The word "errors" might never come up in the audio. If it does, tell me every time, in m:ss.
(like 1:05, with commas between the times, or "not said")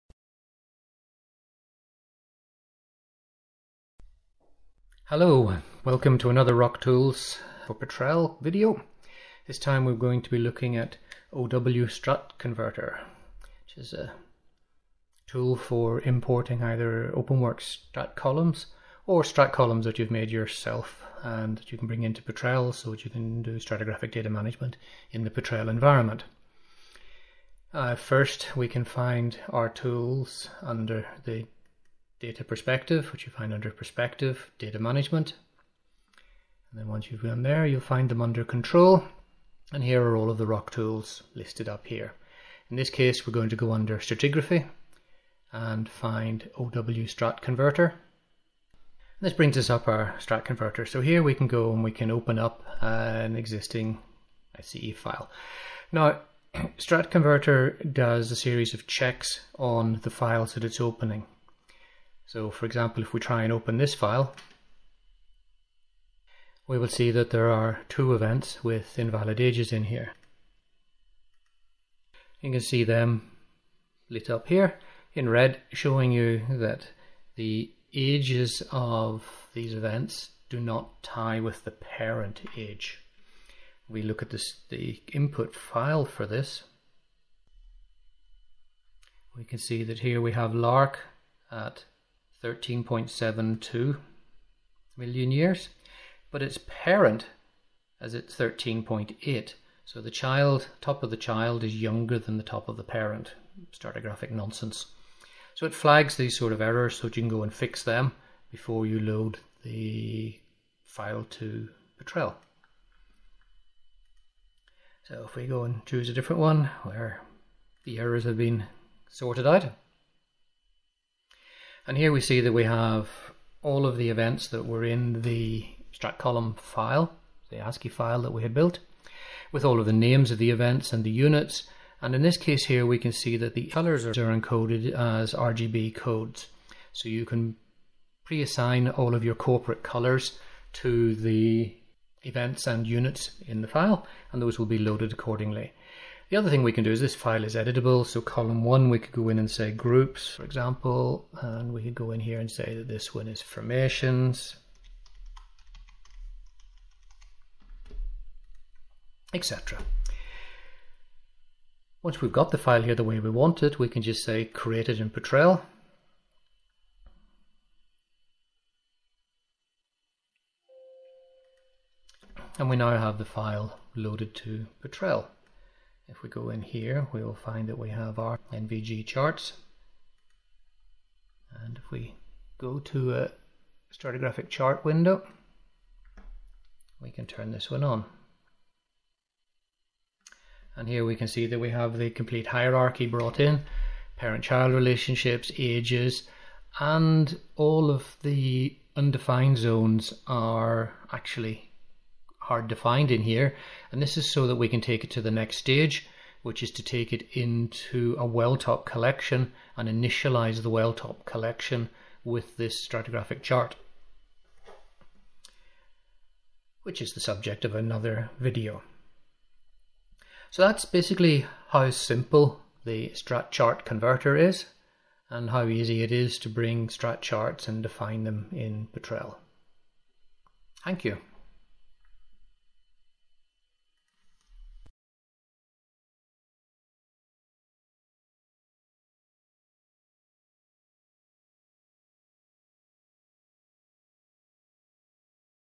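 1:46, 1:57.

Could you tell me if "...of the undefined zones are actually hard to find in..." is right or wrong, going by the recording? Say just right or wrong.
right.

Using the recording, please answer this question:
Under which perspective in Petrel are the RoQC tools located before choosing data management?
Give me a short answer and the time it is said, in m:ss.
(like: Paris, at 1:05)
data perspective, at 0:32.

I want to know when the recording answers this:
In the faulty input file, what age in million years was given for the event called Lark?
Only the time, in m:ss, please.
1:32.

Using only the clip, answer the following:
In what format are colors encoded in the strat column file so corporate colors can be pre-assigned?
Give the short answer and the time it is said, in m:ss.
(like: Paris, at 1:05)
RGB codes, at 2:15.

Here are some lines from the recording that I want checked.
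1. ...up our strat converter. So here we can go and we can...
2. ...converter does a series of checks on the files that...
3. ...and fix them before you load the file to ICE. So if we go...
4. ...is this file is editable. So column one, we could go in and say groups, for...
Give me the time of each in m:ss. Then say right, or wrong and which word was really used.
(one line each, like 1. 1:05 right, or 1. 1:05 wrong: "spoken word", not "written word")
1. 0:49 right
2. 0:57 right
3. 1:47 wrong: "Petrel", not "ICE"
4. 2:26 right.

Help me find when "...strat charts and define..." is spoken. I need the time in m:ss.
3:46.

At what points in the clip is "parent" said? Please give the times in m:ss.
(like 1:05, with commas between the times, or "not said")
1:21, 1:36, 1:42, 3:14.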